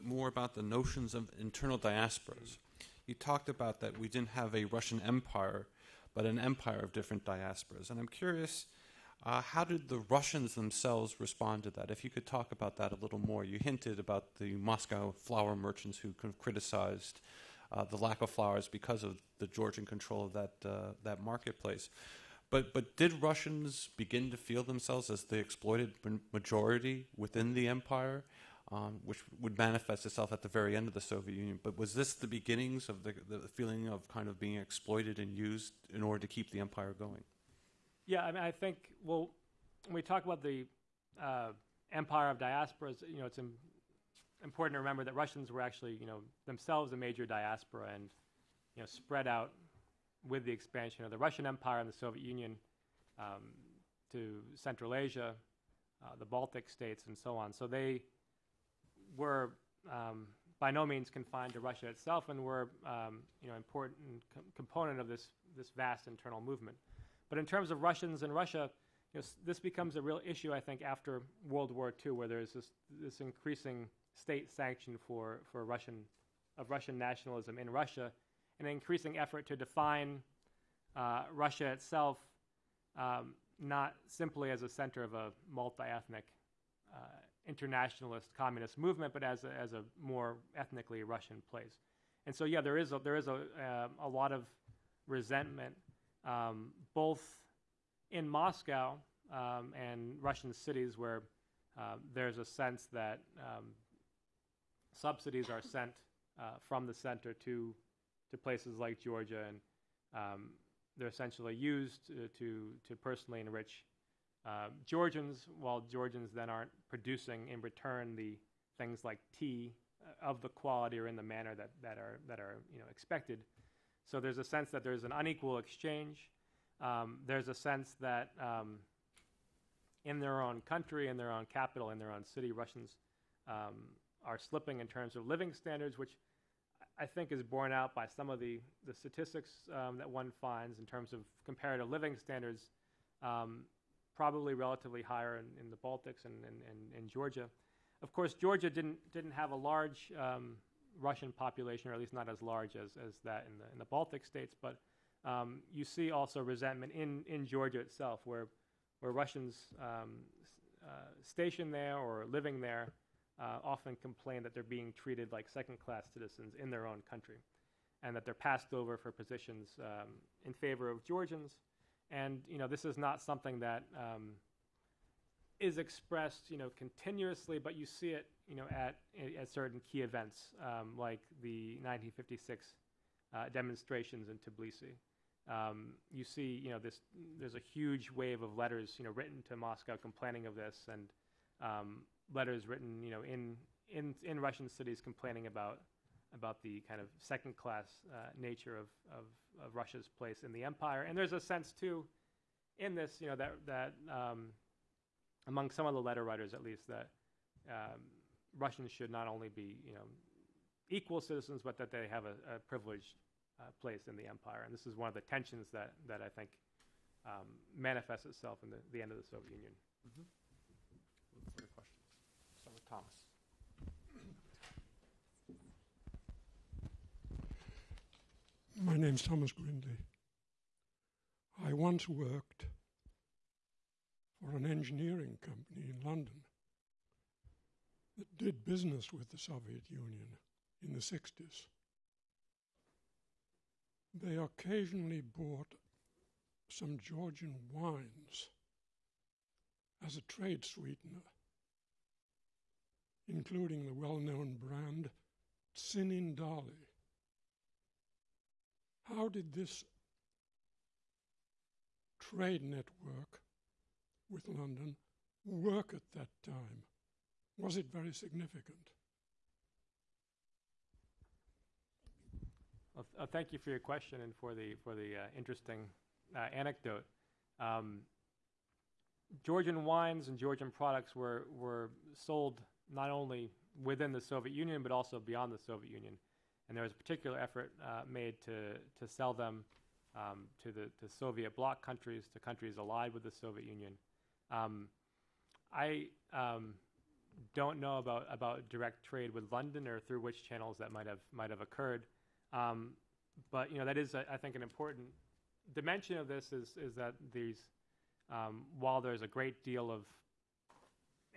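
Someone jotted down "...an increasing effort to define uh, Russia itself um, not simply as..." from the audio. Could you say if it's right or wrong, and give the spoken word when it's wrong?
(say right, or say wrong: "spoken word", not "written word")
right.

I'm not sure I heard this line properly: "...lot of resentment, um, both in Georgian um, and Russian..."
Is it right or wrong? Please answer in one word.
wrong.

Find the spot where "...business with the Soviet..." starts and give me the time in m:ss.
3:58.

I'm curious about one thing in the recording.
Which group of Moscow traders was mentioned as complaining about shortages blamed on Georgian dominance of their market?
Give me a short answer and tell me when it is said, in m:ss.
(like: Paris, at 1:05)
flower merchants, at 0:15.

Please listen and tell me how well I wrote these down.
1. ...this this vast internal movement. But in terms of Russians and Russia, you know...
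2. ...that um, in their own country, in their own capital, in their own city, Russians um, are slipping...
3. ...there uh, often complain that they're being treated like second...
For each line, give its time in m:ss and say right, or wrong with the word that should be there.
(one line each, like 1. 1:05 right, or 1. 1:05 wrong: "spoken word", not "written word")
1. 1:05 right
2. 2:07 right
3. 2:42 right.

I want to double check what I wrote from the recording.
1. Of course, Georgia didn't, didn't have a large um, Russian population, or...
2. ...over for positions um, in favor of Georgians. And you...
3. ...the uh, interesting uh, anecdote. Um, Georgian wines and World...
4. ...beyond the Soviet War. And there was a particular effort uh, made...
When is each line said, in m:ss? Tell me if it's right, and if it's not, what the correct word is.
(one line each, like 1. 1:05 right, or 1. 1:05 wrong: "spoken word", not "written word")
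1. 2:28 right
2. 2:48 right
3. 4:34 wrong: "Georgian", not "World"
4. 4:45 wrong: "Union", not "War".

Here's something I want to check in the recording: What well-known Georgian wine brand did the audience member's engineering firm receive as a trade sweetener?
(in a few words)
Tsinandali.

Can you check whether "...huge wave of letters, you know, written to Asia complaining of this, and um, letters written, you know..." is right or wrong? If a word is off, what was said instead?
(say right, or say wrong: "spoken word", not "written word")
wrong: "Moscow", not "Asia".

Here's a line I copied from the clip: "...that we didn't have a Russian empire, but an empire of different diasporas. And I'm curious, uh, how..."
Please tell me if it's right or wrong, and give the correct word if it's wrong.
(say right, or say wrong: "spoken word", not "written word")
right.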